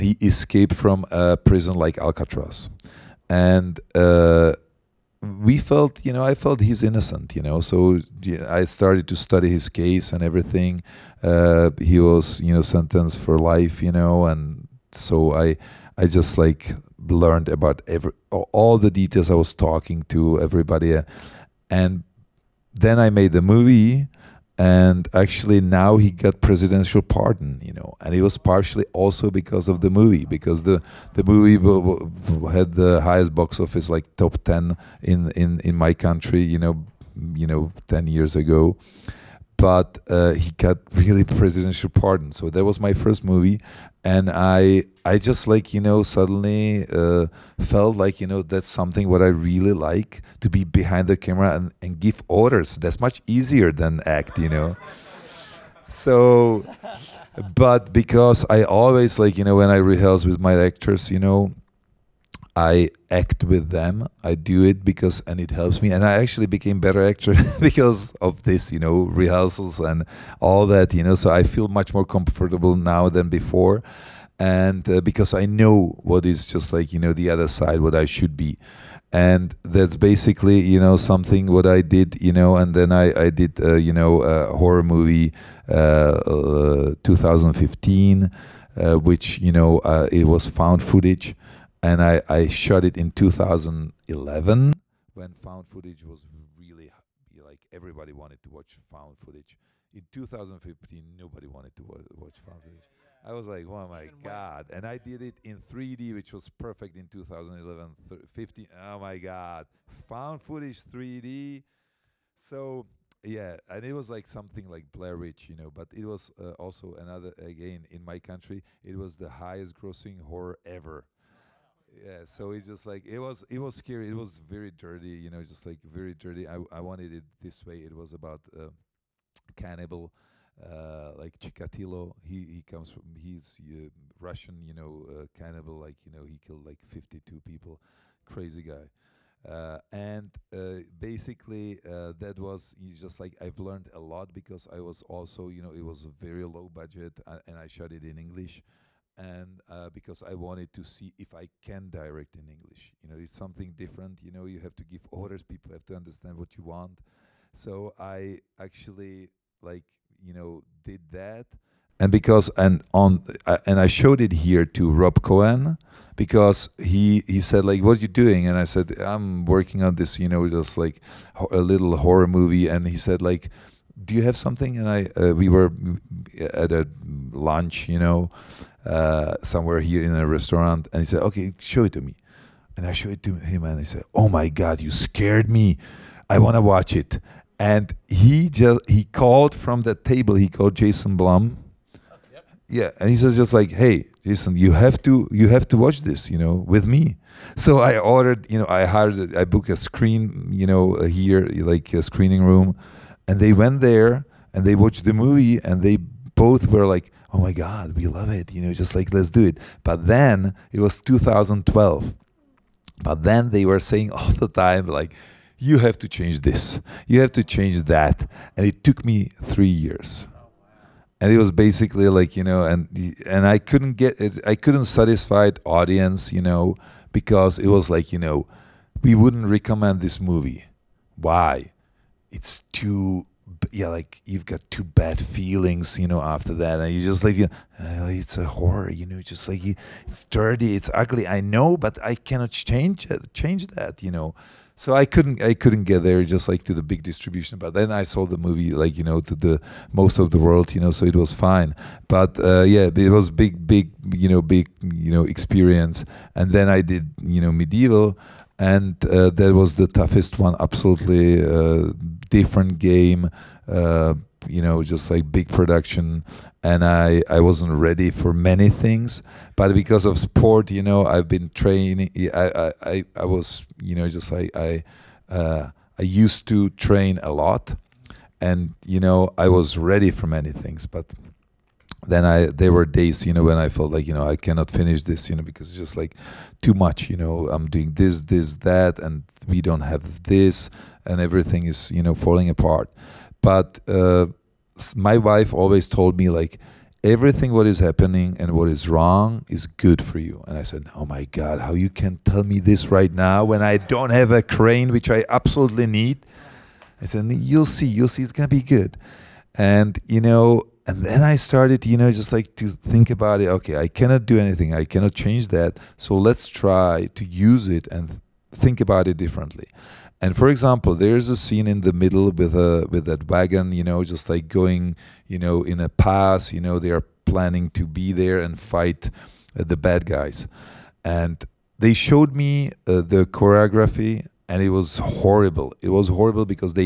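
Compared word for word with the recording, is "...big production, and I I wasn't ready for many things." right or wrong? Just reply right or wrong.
right.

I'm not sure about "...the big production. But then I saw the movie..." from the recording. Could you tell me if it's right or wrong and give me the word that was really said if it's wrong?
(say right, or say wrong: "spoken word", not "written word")
wrong: "distribution", not "production".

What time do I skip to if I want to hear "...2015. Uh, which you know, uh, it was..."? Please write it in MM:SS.
01:27.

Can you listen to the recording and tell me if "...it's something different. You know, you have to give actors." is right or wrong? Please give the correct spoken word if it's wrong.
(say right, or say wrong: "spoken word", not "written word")
wrong: "orders", not "actors".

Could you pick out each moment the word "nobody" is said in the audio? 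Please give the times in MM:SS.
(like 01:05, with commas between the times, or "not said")
01:41.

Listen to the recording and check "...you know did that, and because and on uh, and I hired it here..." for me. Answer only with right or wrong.
wrong.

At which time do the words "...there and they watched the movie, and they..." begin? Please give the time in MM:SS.
03:23.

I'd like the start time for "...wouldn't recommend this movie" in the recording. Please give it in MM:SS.
03:49.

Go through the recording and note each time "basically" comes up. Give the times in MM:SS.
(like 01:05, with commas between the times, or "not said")
01:19, 02:20, 03:41.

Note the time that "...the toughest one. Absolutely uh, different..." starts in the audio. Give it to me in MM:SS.
04:19.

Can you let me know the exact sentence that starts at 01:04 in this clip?
I do it because, and it helps me.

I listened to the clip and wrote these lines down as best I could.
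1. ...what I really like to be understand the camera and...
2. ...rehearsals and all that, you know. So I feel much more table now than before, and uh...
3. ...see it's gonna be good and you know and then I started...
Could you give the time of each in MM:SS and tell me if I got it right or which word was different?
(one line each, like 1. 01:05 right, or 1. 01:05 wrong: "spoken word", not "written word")
1. 00:49 wrong: "behind", not "understand"
2. 01:09 wrong: "comfortable", not "table"
3. 05:08 right.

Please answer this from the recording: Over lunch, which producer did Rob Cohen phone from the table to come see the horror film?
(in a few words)
Jason Blum.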